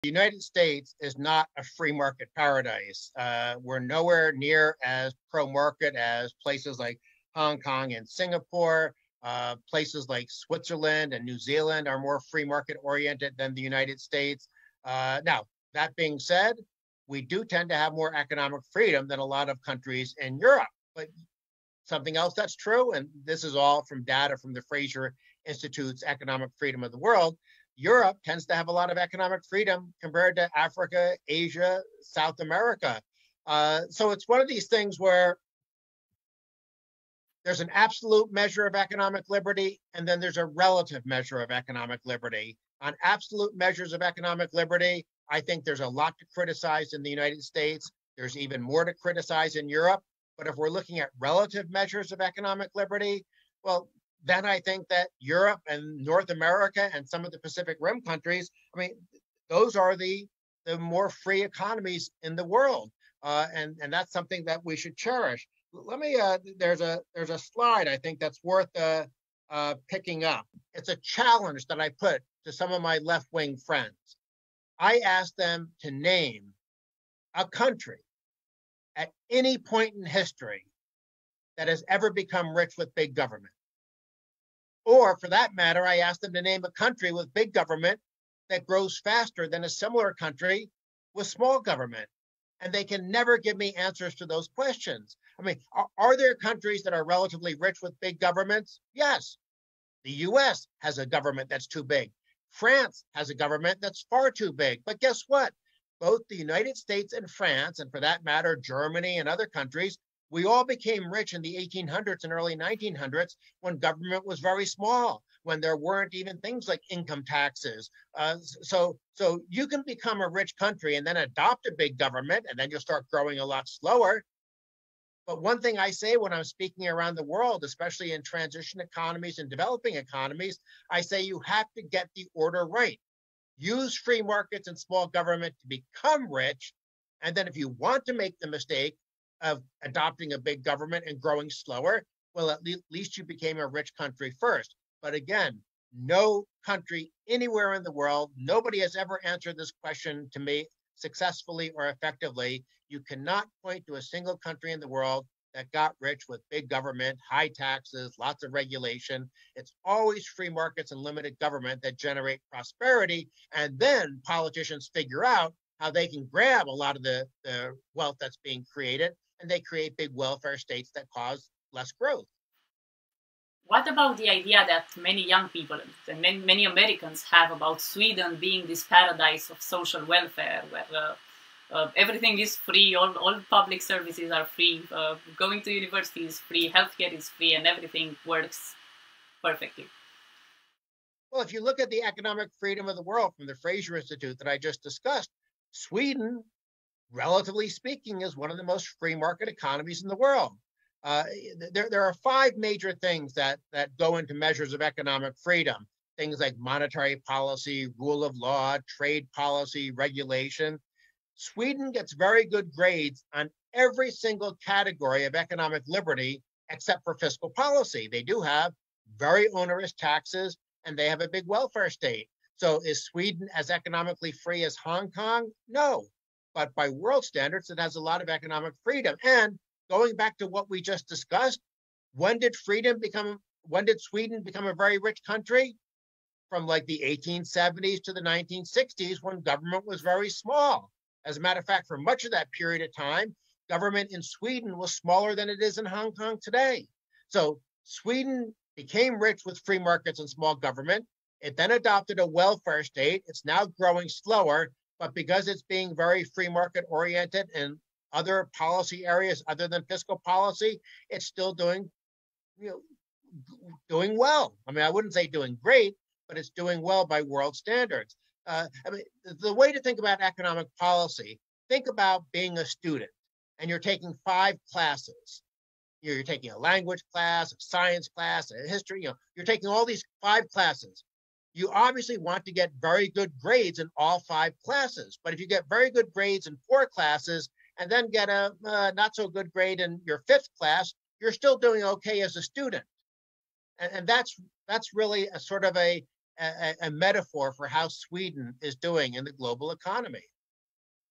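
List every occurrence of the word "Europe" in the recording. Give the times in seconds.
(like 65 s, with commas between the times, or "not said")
20 s, 27 s, 49 s, 55 s.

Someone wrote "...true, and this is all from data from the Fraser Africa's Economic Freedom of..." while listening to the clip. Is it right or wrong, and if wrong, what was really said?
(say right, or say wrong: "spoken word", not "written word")
wrong: "Institute", not "Africa".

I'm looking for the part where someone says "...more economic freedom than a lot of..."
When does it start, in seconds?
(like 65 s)
17 s.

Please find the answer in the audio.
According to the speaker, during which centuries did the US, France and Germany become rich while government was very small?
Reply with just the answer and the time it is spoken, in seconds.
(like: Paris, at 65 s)
1800s and early 1900s, at 111 s.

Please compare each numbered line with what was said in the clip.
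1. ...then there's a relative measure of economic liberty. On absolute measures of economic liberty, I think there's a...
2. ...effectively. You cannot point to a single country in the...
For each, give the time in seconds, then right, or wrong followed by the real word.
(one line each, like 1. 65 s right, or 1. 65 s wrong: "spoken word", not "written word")
1. 40 s right
2. 151 s right.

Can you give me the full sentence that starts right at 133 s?
Use free markets and small government to become rich.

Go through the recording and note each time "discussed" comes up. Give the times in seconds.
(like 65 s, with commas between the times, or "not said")
194 s, 231 s.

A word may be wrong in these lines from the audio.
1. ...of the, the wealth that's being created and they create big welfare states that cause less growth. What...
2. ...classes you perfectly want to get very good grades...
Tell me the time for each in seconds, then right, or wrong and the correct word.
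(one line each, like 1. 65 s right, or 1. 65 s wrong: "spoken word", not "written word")
1. 166 s right
2. 280 s wrong: "obviously", not "perfectly".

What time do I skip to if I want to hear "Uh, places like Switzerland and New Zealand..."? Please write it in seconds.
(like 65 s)
9 s.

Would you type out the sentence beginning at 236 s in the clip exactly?
From like the 1870s to the 1960s when government was very small.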